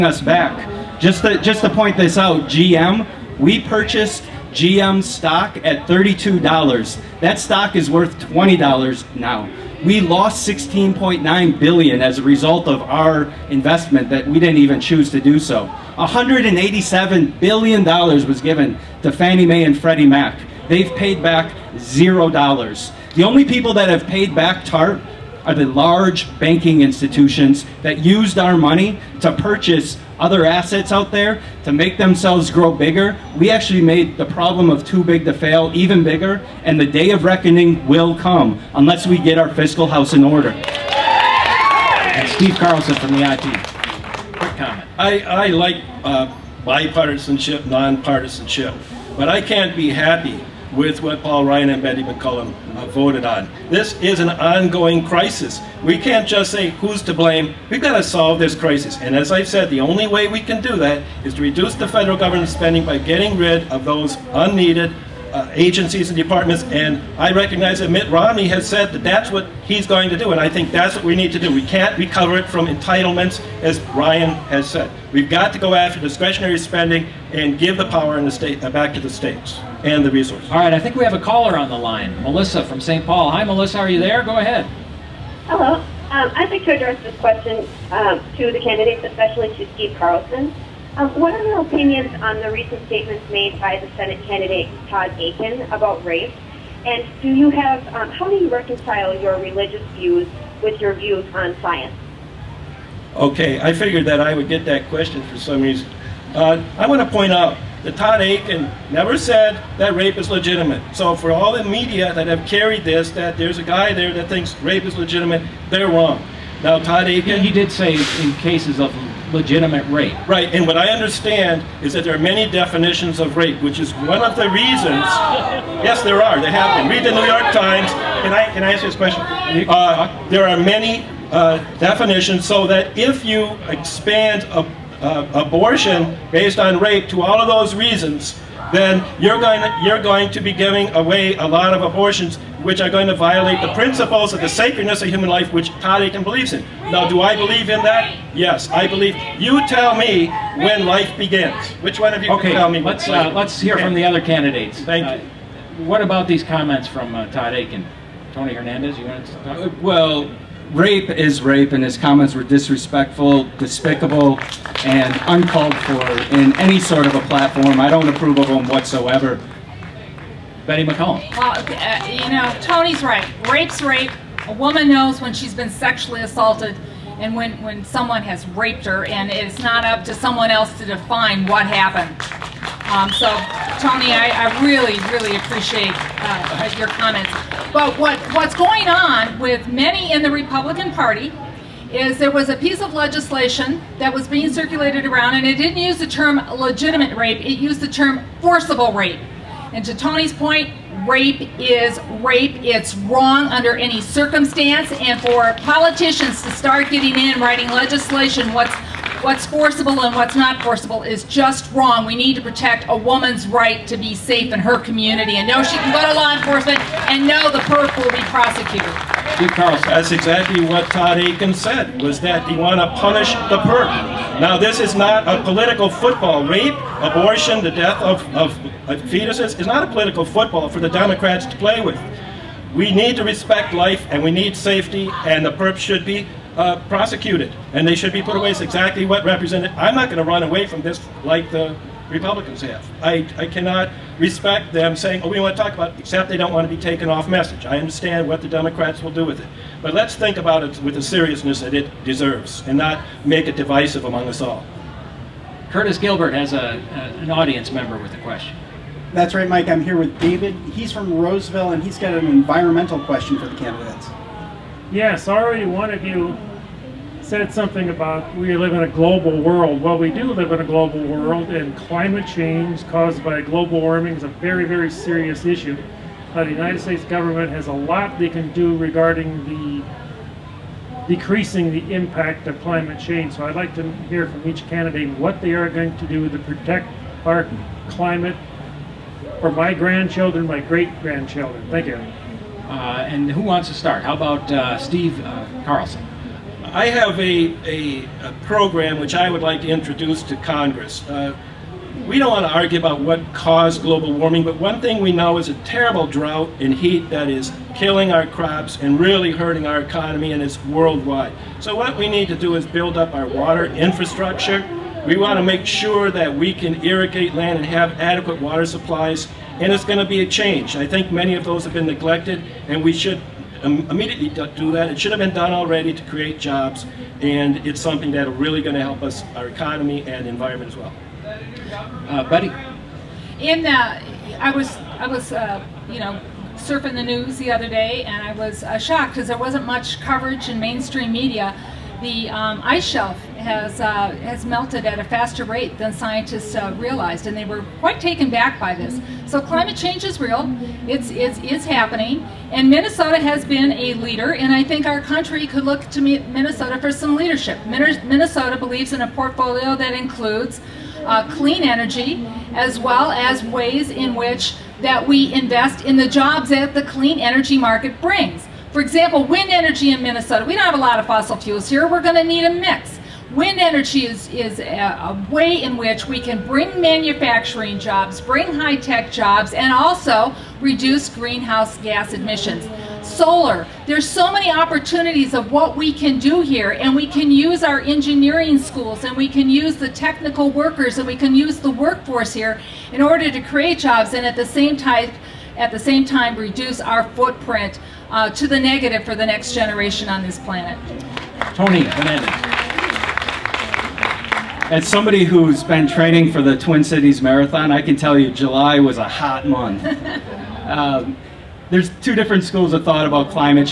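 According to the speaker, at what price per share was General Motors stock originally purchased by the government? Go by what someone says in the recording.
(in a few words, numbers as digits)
$32.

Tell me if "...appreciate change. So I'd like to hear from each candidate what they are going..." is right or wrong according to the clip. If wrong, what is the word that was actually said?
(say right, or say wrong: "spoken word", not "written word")
wrong: "climate", not "appreciate".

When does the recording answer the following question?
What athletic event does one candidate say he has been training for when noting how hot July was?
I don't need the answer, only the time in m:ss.
6:46.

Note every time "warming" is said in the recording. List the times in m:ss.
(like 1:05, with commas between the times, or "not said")
4:33, 5:04.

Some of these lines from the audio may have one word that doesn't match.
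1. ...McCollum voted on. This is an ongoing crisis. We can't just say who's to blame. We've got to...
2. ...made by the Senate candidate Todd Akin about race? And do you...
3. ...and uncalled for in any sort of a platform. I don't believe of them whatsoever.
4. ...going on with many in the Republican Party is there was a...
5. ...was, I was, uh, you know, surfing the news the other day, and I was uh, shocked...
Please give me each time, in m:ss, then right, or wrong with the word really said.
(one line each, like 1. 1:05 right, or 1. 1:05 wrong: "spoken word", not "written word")
1. 0:52 right
2. 1:33 right
3. 2:44 wrong: "approve", not "believe"
4. 3:08 right
5. 5:34 right.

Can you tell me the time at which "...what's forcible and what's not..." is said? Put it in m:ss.
3:29.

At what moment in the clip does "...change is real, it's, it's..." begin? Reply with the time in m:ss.
5:49.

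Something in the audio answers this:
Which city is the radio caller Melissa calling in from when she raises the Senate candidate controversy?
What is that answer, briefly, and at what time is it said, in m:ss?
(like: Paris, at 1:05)
St. Paul, at 1:22.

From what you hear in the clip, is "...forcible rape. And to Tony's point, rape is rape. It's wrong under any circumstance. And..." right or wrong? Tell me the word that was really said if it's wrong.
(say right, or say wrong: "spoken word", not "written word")
right.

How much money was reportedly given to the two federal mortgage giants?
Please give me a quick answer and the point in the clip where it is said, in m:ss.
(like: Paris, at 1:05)
187 billion dollars, at 0:15.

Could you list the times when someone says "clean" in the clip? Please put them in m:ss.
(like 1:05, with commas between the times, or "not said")
6:01, 6:06.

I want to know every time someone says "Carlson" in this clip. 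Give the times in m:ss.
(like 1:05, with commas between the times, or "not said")
0:42, 1:29, 3:39, 4:55.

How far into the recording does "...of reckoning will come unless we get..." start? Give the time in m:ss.
0:37.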